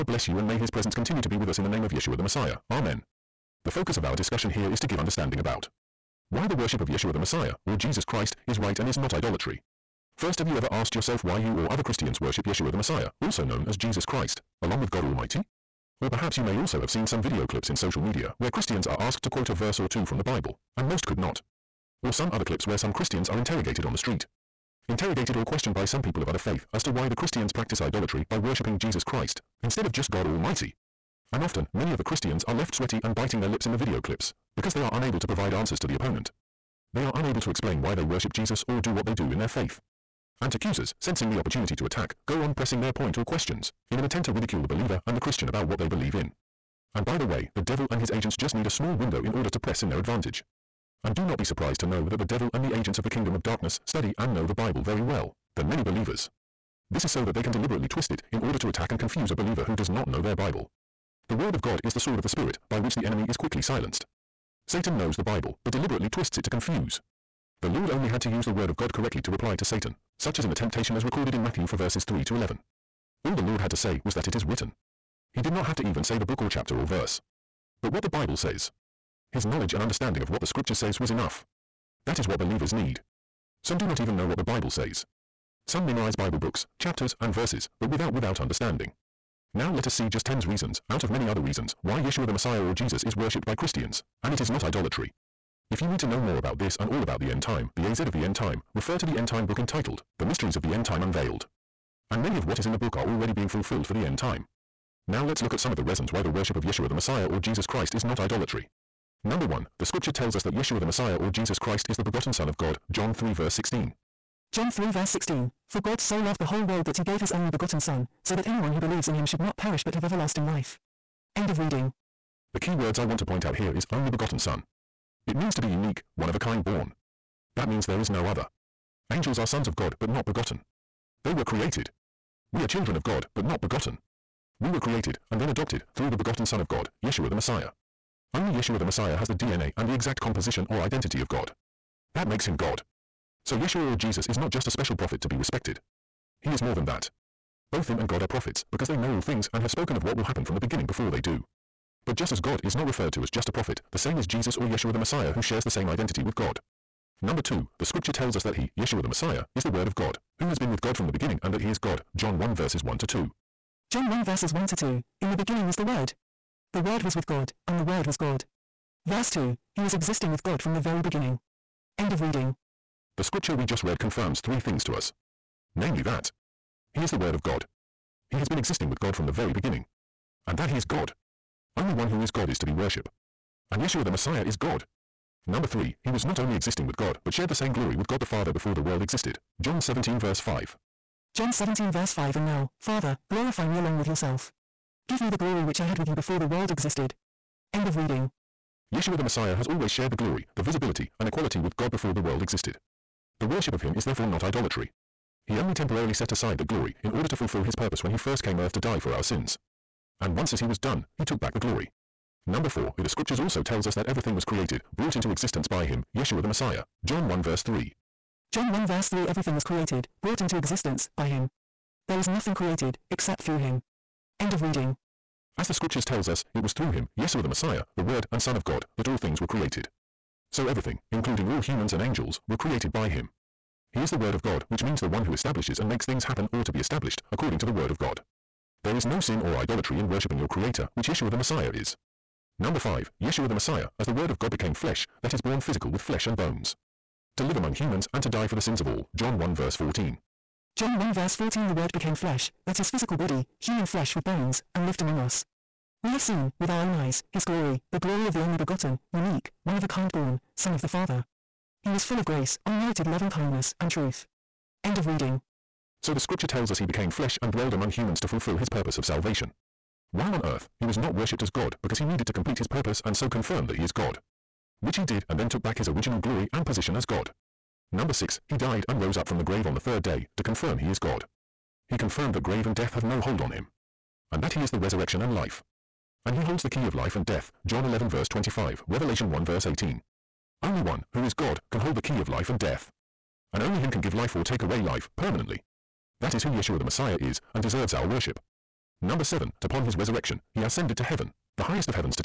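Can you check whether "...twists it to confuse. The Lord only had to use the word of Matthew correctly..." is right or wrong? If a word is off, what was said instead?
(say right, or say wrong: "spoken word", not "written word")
wrong: "God", not "Matthew".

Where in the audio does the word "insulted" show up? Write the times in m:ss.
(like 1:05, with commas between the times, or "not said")
not said.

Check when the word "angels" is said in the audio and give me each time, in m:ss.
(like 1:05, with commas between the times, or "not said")
2:09, 3:52.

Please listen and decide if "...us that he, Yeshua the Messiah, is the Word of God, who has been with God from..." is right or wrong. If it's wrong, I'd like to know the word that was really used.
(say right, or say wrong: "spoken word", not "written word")
right.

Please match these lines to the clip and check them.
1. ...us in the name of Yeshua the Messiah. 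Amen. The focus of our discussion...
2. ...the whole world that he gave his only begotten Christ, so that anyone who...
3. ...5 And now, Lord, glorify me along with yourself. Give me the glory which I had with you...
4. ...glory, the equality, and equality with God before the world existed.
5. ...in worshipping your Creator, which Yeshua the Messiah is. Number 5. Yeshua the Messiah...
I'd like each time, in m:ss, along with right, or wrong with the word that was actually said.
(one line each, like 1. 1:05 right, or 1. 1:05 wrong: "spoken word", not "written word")
1. 0:01 right
2. 1:56 wrong: "Son", not "Christ"
3. 3:12 wrong: "Father", not "Lord"
4. 3:20 wrong: "visibility", not "equality"
5. 3:59 right.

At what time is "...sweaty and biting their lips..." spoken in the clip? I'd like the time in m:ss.
0:32.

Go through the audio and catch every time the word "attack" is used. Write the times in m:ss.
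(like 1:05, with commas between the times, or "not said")
0:41, 0:58.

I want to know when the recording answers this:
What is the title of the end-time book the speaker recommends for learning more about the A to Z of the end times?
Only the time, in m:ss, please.
1:40.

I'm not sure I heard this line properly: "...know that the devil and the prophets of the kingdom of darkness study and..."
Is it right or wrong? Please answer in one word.
wrong.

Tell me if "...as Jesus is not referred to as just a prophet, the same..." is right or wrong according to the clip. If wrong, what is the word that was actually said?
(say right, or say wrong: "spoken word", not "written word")
wrong: "God", not "Jesus".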